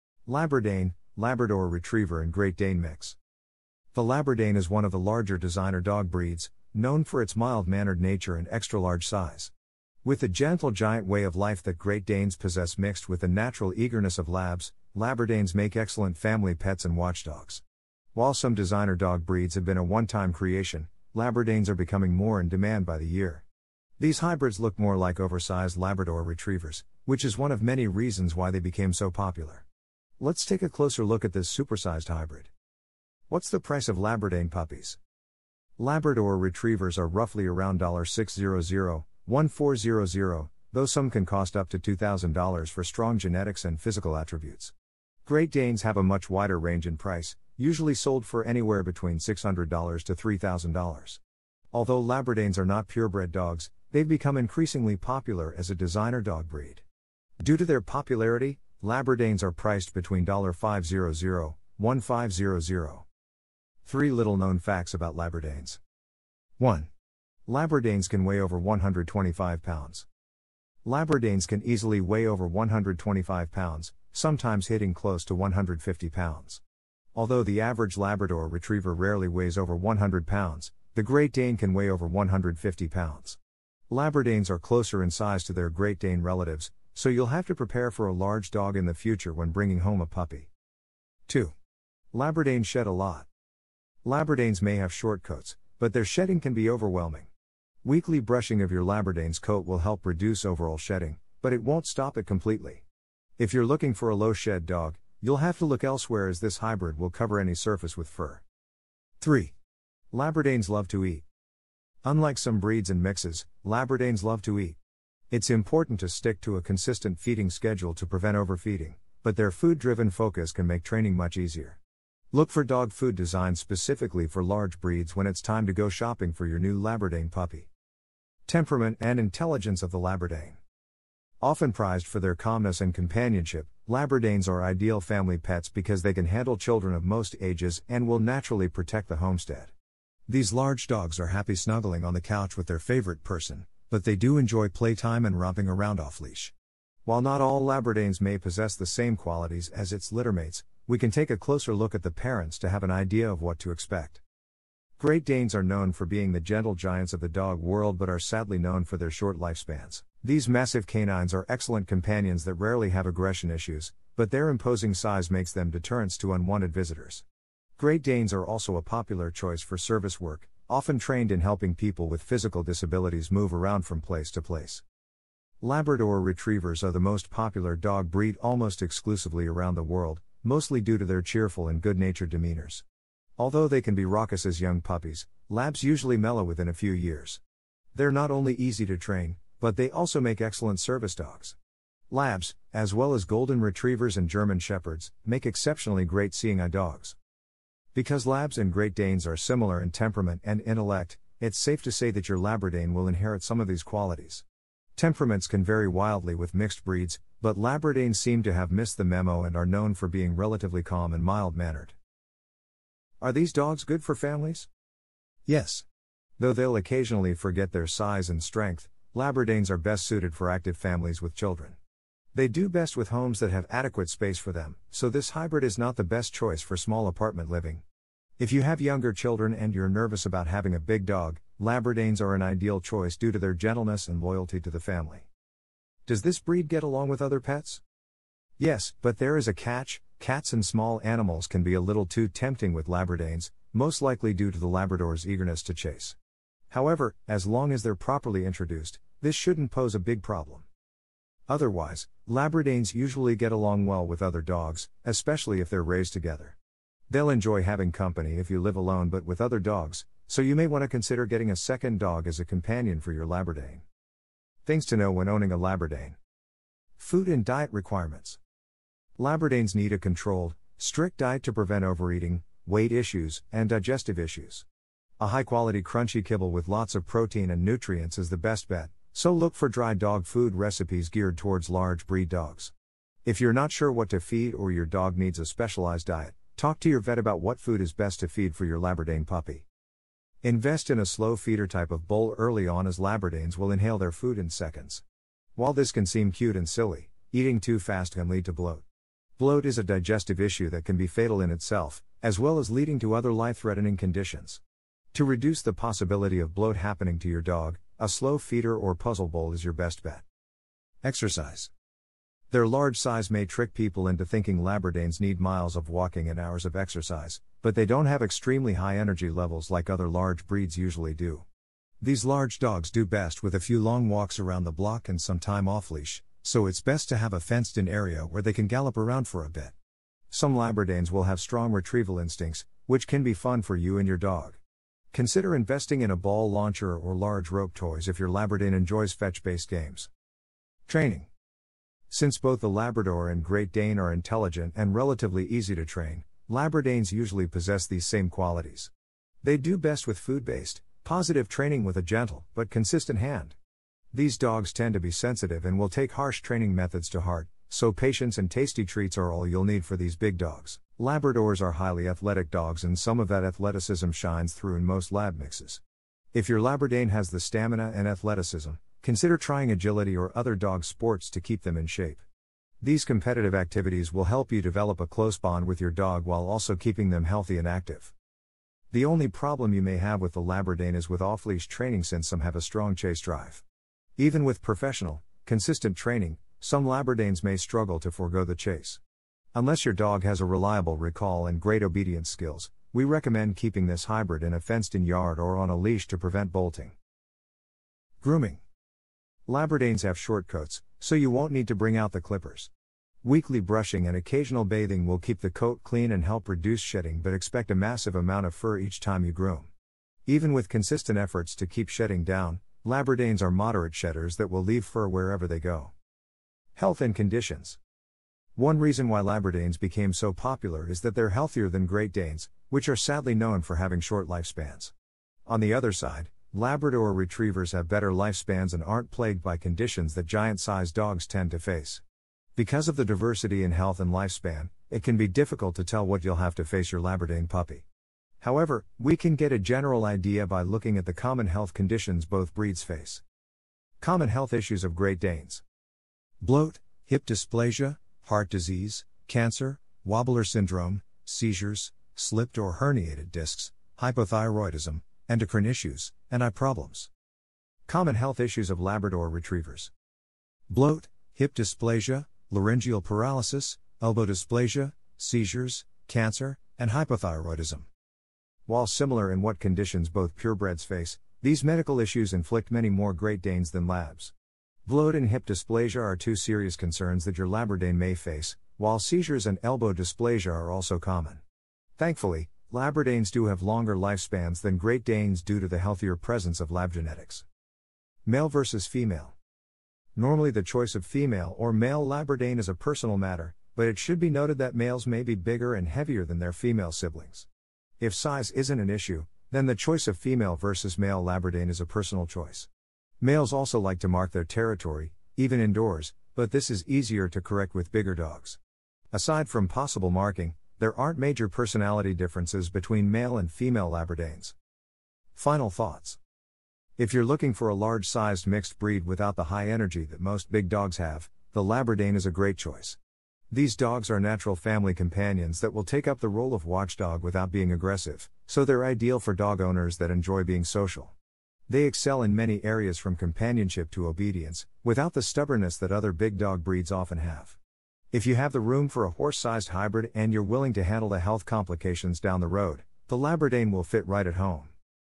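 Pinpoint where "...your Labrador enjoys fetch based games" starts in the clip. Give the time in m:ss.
5:38.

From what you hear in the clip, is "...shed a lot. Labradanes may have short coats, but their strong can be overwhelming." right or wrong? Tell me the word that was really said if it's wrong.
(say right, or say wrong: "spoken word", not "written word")
wrong: "shedding", not "strong".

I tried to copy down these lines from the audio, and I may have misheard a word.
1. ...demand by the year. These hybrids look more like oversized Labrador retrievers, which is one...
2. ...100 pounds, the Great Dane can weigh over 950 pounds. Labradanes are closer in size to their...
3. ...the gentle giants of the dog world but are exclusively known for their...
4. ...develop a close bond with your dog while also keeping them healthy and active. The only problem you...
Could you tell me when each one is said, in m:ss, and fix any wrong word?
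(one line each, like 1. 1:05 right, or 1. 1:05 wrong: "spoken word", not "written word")
1. 0:22 right
2. 1:19 wrong: "150", not "950"
3. 2:36 wrong: "sadly", not "exclusively"
4. 6:14 right.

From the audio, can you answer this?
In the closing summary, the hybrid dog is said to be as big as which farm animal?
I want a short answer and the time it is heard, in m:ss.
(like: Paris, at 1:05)
Horse sized, at 8:59.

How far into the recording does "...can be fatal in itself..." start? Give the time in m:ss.
5:00.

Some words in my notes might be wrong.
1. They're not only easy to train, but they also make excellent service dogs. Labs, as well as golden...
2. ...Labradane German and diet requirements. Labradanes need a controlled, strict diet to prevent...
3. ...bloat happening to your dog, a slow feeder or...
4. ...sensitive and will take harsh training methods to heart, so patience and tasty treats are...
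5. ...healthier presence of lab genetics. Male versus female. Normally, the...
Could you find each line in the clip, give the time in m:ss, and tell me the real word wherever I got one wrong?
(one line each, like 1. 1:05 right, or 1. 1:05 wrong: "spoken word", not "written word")
1. 3:07 right
2. 4:25 wrong: "Food", not "German"
3. 5:06 right
4. 5:55 right
5. 8:05 right.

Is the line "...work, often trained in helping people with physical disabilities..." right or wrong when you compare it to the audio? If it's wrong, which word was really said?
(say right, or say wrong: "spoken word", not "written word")
right.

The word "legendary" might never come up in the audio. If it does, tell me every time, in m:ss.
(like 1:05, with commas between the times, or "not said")
not said.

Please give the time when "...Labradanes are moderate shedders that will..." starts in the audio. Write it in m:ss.
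6:52.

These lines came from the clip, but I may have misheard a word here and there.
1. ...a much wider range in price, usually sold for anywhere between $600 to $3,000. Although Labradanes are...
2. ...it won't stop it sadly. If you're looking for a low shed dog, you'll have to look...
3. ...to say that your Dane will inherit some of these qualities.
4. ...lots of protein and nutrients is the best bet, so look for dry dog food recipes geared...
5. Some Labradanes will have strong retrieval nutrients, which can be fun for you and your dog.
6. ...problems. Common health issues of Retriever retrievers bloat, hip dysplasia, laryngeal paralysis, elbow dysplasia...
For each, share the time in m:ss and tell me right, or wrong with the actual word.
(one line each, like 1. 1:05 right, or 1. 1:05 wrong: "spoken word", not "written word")
1. 0:45 right
2. 1:41 wrong: "completely", not "sadly"
3. 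3:21 wrong: "Labradane", not "Dane"
4. 4:36 right
5. 5:30 wrong: "instincts", not "nutrients"
6. 7:36 wrong: "Labrador", not "Retriever".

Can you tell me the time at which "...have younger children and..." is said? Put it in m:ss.
3:48.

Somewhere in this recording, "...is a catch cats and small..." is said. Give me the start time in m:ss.
3:59.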